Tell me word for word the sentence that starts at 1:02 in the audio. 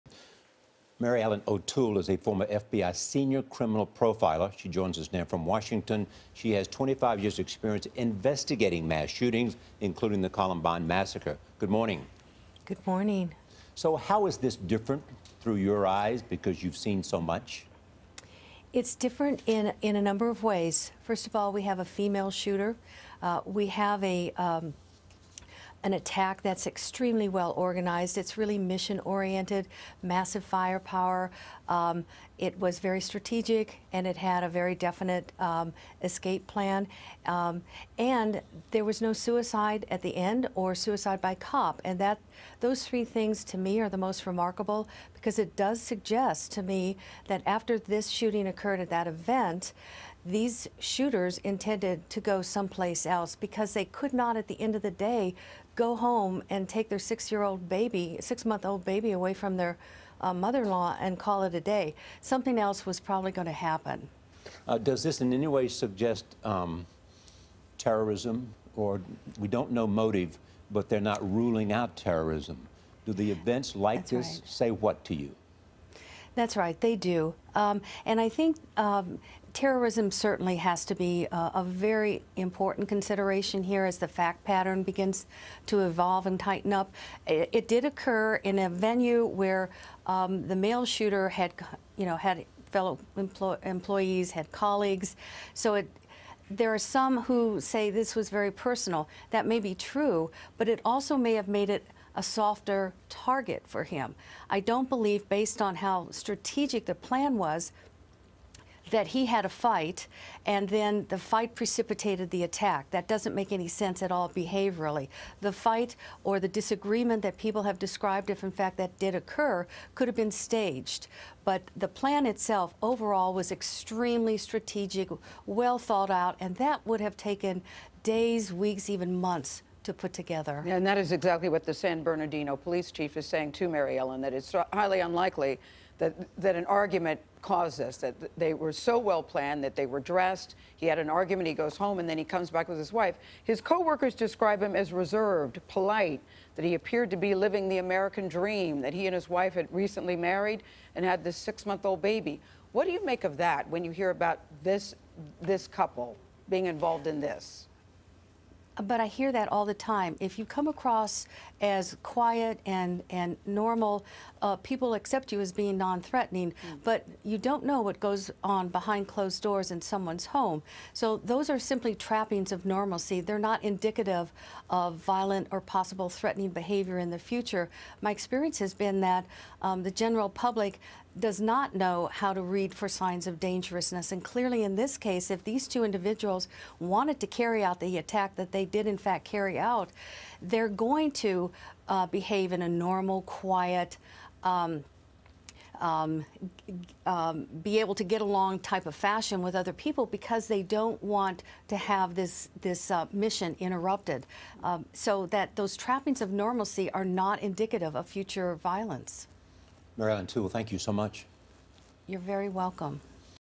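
Something else was probably going to happen.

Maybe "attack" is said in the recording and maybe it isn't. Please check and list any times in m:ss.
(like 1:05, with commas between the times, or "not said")
0:25, 1:52, 3:07.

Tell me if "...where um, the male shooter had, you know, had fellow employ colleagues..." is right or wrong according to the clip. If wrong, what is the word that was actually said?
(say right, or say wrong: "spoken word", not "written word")
wrong: "employees", not "colleagues".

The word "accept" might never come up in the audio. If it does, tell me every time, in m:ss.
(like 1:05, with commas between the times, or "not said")
2:44.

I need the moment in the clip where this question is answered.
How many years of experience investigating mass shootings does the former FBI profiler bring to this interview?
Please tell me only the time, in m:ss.
0:06.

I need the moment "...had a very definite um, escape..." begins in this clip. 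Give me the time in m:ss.
0:34.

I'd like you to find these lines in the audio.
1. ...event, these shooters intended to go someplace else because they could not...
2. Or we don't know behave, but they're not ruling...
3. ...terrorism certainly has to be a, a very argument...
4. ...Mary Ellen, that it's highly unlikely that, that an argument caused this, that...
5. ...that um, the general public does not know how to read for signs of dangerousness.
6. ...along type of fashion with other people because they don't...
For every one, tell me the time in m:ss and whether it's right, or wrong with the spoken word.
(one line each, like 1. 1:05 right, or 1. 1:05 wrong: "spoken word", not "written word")
1. 0:49 right
2. 1:08 wrong: "motive", not "behave"
3. 1:19 wrong: "important", not "argument"
4. 2:13 right
5. 2:59 right
6. 3:18 right.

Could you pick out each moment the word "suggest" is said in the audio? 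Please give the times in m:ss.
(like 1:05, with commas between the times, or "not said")
0:45, 1:05.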